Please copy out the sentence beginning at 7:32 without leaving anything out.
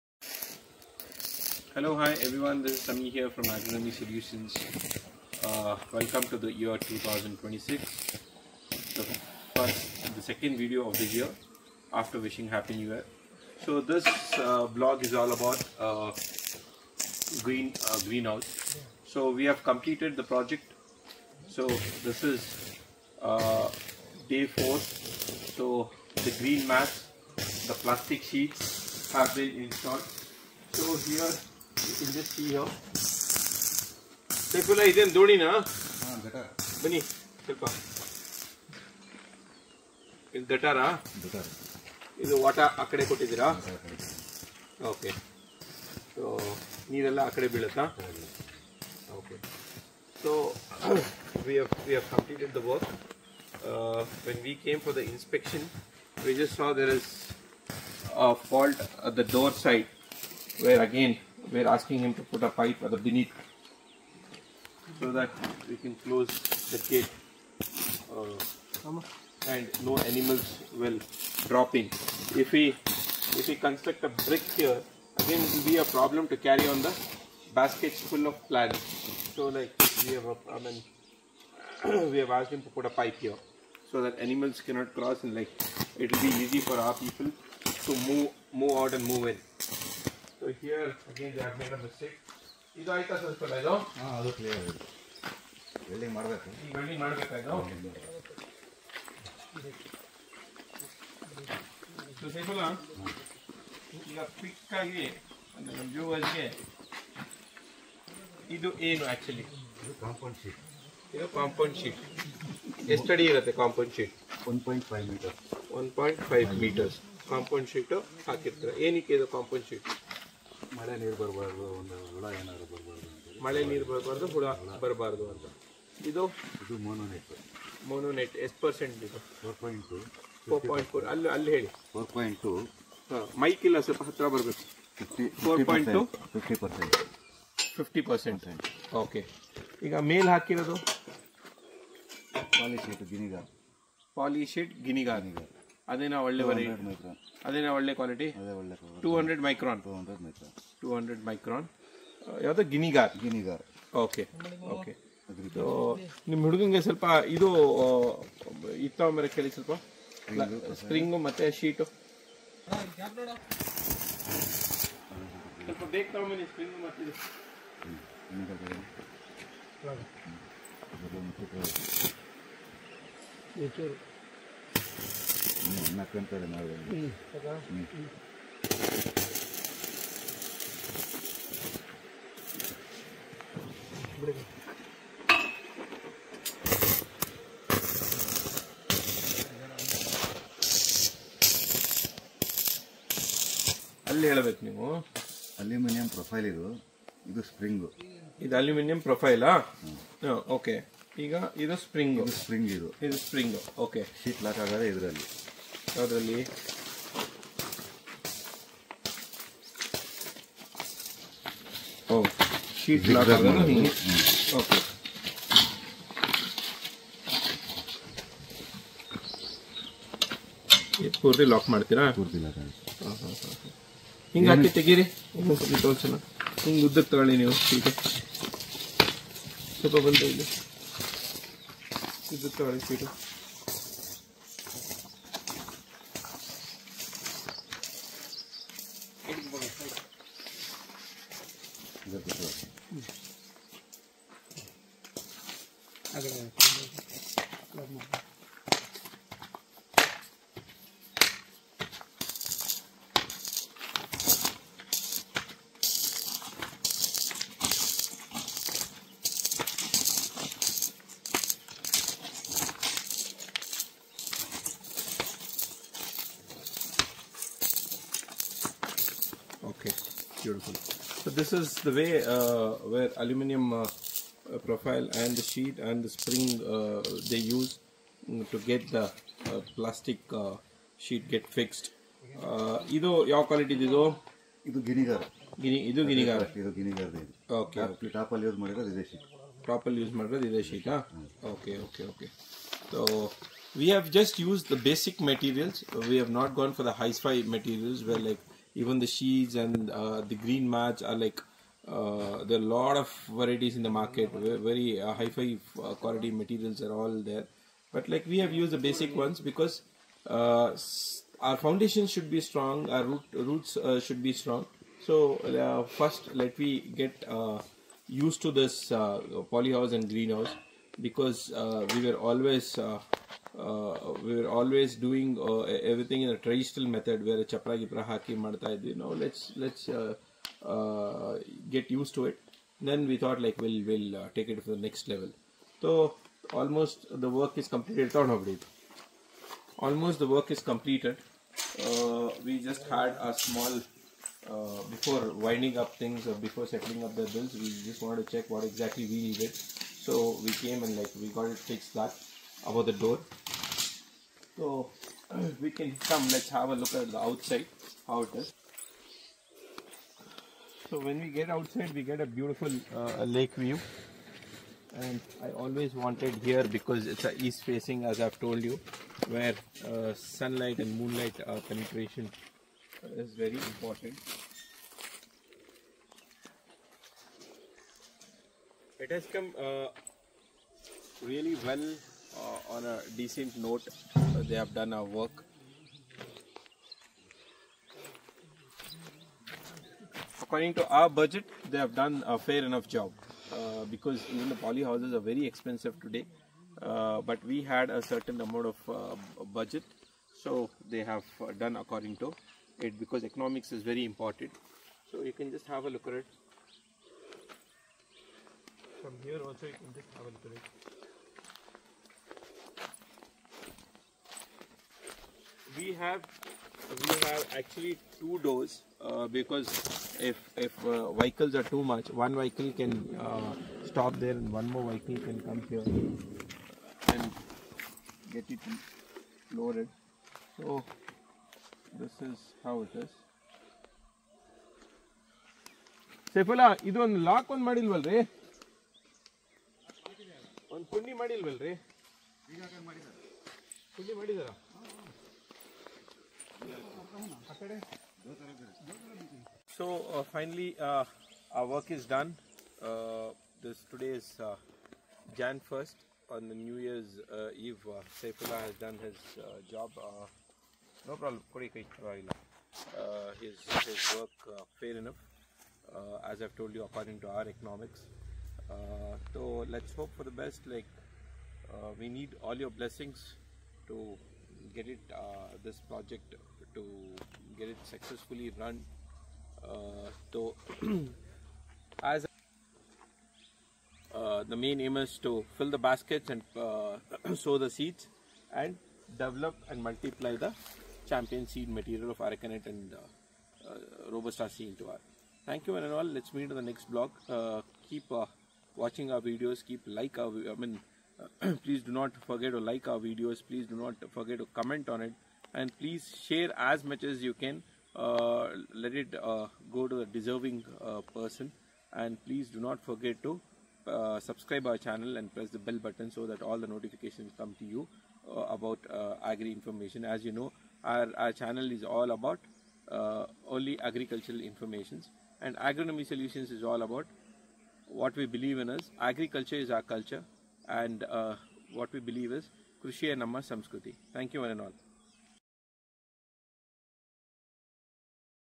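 Uh, this today is uh, Jan 1st on the New Year's uh, Eve.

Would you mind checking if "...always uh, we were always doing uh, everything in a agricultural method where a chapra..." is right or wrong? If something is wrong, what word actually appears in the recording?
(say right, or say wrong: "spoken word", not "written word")
wrong: "traditional", not "agricultural".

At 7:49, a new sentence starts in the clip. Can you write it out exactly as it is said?
so let's hope for the best.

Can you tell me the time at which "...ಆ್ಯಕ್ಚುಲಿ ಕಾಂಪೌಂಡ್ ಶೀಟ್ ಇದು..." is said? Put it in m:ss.
1:49.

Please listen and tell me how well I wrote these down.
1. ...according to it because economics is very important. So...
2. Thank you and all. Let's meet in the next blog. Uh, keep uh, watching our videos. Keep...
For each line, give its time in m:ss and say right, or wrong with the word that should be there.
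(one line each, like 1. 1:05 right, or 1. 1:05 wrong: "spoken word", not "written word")
1. 6:41 right
2. 8:15 right.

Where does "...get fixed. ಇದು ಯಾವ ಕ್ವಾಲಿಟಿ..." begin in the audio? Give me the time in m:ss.
4:41.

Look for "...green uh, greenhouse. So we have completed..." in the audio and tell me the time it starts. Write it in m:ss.
0:17.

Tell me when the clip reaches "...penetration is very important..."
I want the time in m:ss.
6:11.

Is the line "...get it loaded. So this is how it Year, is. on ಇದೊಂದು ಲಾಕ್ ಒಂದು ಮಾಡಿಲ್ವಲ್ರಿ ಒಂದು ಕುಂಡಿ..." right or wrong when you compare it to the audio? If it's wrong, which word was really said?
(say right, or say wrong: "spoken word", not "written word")
wrong: "Saifullah", not "Year".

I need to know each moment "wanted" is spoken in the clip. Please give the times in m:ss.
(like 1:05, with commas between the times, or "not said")
5:48, 6:05.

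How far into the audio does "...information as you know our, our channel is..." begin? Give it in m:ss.
8:39.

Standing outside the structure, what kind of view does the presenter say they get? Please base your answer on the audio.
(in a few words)
Lake view.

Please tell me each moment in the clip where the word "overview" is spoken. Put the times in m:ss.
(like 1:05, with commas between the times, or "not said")
not said.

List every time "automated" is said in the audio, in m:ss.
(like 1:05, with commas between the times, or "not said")
not said.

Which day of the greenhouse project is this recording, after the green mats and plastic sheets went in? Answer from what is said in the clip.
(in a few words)
Day four.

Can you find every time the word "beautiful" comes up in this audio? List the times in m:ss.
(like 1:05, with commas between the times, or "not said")
4:30, 6:02.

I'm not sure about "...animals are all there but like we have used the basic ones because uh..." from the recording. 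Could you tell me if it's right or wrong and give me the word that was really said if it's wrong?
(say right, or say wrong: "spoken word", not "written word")
wrong: "materials", not "animals".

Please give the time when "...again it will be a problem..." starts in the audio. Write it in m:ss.
1:15.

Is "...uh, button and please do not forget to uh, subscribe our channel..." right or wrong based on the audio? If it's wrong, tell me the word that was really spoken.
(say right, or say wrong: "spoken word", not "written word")
wrong: "person", not "button".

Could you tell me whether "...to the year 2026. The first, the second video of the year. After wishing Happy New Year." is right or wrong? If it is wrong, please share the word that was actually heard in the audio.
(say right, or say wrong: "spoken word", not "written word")
right.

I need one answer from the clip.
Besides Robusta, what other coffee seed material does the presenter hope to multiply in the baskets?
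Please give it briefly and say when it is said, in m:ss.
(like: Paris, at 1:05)
Aracanet, at 8:12.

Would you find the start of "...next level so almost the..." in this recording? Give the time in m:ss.
5:34.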